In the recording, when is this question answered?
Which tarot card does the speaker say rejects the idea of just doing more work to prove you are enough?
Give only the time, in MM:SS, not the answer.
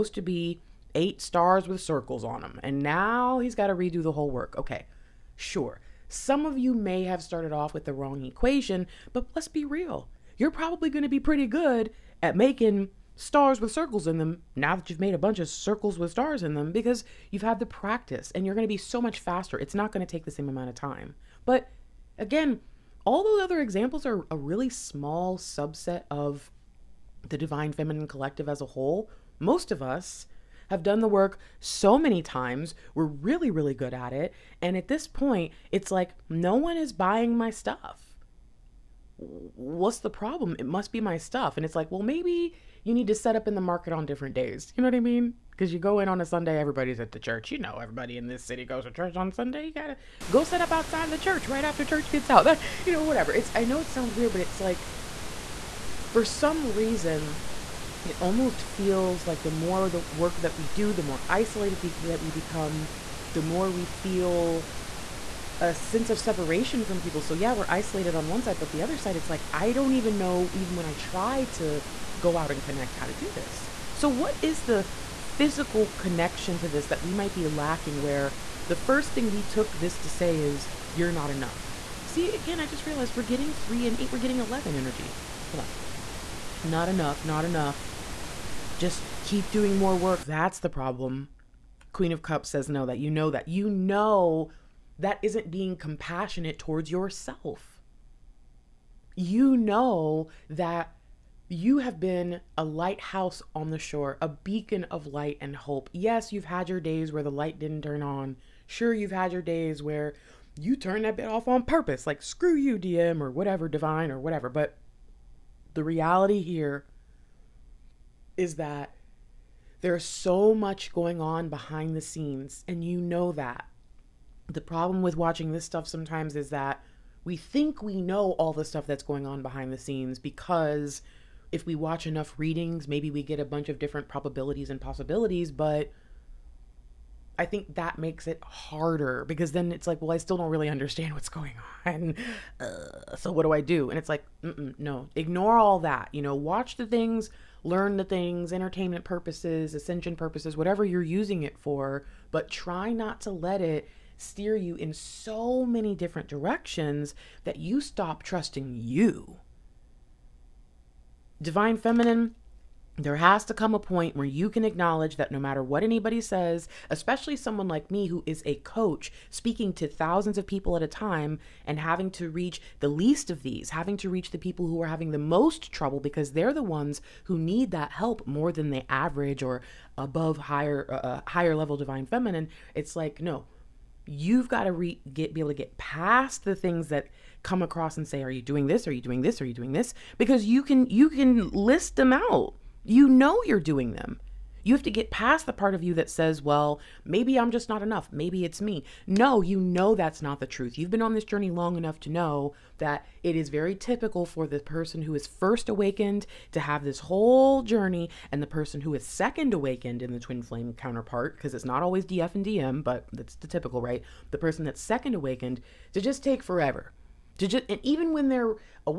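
01:31.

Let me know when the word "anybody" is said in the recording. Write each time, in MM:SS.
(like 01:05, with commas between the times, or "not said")
02:45.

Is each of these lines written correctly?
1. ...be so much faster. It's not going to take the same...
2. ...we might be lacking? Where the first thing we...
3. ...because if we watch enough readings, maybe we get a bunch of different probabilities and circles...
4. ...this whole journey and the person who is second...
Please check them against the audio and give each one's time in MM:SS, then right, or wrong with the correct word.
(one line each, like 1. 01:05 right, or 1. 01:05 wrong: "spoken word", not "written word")
1. 00:18 right
2. 01:17 right
3. 02:10 wrong: "possibilities", not "circles"
4. 03:26 right.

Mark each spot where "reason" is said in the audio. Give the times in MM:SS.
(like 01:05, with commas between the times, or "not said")
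00:56.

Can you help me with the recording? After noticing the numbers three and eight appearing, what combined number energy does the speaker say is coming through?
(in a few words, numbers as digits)
11.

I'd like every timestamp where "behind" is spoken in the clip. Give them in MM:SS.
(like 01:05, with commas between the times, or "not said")
02:01, 02:09.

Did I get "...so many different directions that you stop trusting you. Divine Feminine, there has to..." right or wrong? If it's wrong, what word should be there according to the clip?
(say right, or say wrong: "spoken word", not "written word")
right.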